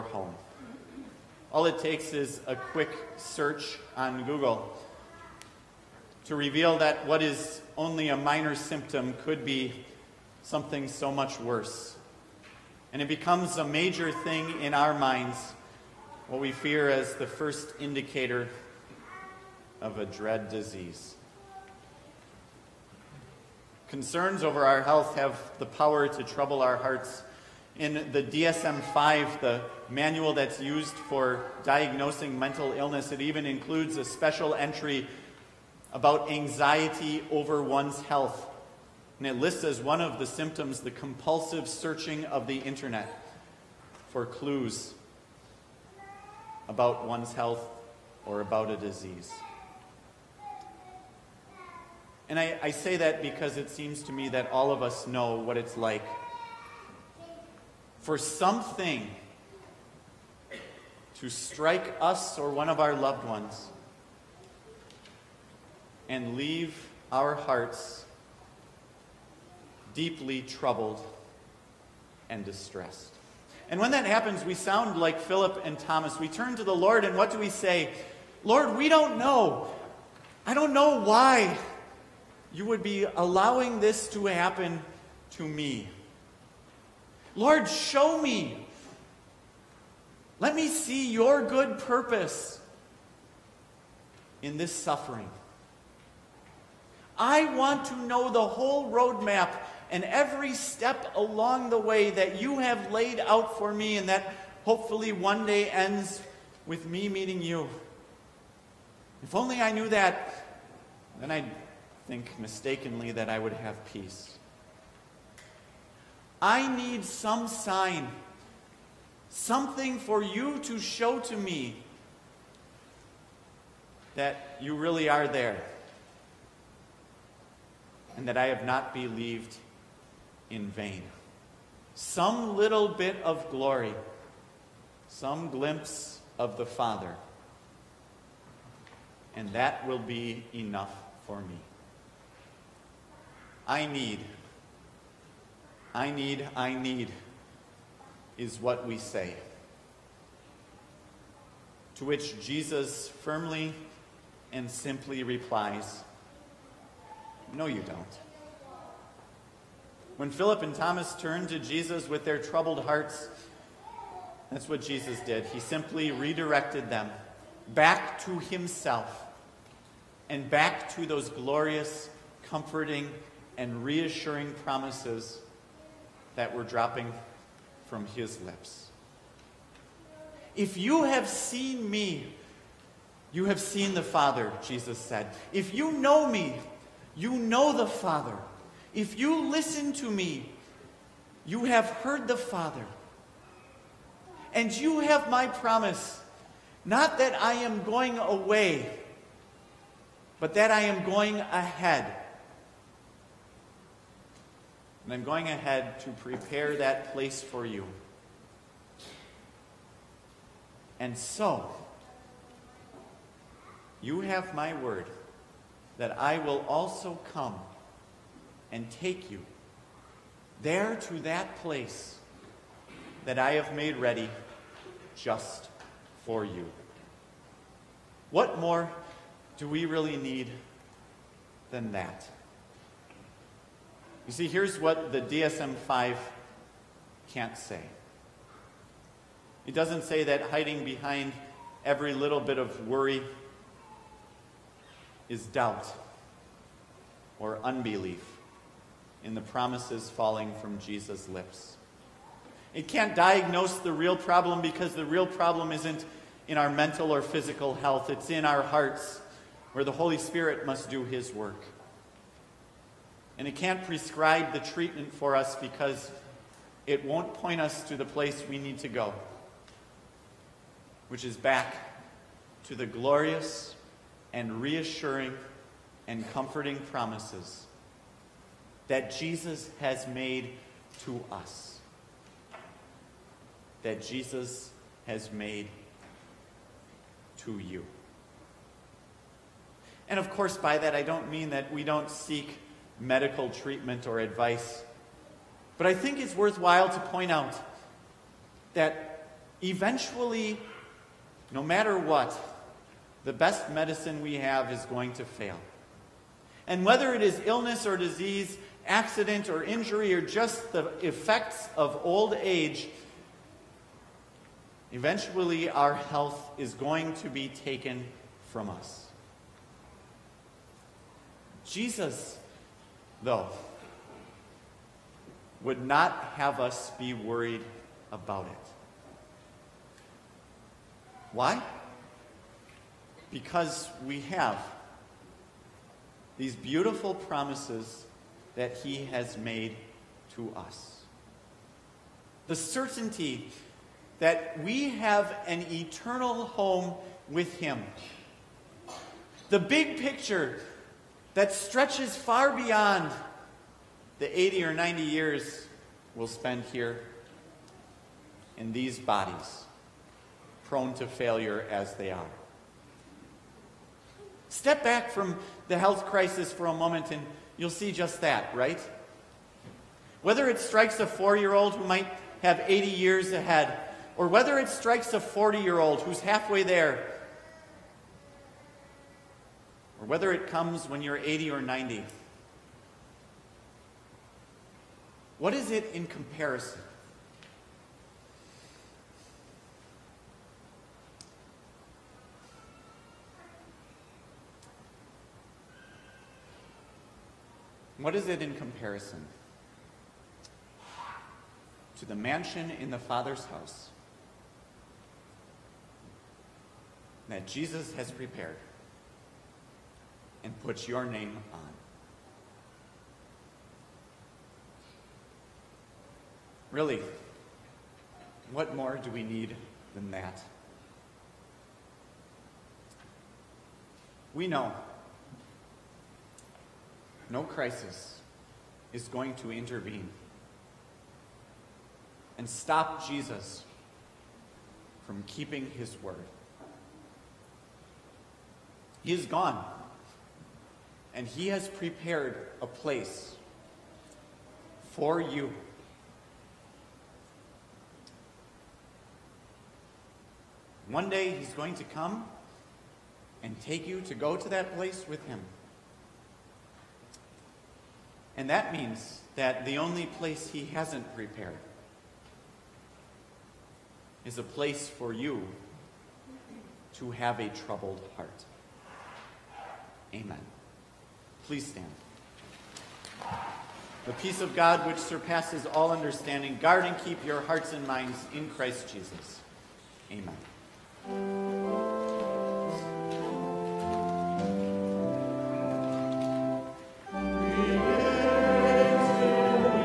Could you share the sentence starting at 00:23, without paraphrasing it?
Concerns over our health have the power to trouble our hearts.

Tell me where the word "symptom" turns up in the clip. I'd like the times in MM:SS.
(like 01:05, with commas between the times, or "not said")
00:08, 00:40.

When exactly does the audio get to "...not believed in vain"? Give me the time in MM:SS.
02:08.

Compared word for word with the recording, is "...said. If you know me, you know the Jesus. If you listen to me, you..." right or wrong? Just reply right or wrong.
wrong.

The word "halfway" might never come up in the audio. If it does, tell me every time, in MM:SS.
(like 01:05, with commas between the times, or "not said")
06:16.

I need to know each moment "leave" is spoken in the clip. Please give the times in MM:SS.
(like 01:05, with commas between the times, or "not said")
01:06.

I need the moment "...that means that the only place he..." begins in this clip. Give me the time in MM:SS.
07:38.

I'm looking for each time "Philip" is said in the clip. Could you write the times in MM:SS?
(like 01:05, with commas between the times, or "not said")
01:15, 02:40.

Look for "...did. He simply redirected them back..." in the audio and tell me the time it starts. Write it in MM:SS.
02:45.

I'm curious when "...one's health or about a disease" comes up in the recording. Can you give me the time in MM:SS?
00:47.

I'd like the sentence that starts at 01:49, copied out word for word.
If only I knew that, then I'd think mistakenly that I would have peace.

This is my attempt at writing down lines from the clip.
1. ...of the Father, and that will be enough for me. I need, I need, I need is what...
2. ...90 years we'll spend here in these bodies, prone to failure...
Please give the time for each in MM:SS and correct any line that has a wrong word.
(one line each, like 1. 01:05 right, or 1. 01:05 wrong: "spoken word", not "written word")
1. 02:16 right
2. 05:54 right.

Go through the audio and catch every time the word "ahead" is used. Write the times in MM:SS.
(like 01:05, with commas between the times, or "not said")
03:21, 03:25, 06:13.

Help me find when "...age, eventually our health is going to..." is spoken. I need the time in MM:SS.
05:12.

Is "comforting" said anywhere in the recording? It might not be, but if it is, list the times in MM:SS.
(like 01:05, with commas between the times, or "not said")
02:52, 04:36.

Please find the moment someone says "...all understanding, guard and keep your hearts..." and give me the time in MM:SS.
07:55.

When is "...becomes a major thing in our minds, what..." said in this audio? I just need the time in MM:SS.
00:13.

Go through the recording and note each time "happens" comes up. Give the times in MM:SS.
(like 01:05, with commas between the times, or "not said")
01:14, 01:24.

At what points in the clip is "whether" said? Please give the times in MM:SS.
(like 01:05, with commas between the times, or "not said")
05:06, 06:10, 06:14, 06:20.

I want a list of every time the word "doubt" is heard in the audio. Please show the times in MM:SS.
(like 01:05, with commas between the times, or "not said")
04:05.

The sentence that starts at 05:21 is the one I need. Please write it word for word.
Jesus, though, would not have us be worried about it.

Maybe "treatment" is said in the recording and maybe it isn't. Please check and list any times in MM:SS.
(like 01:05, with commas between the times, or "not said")
04:24, 04:53.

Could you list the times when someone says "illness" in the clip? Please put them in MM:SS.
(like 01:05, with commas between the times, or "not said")
00:32, 05:07.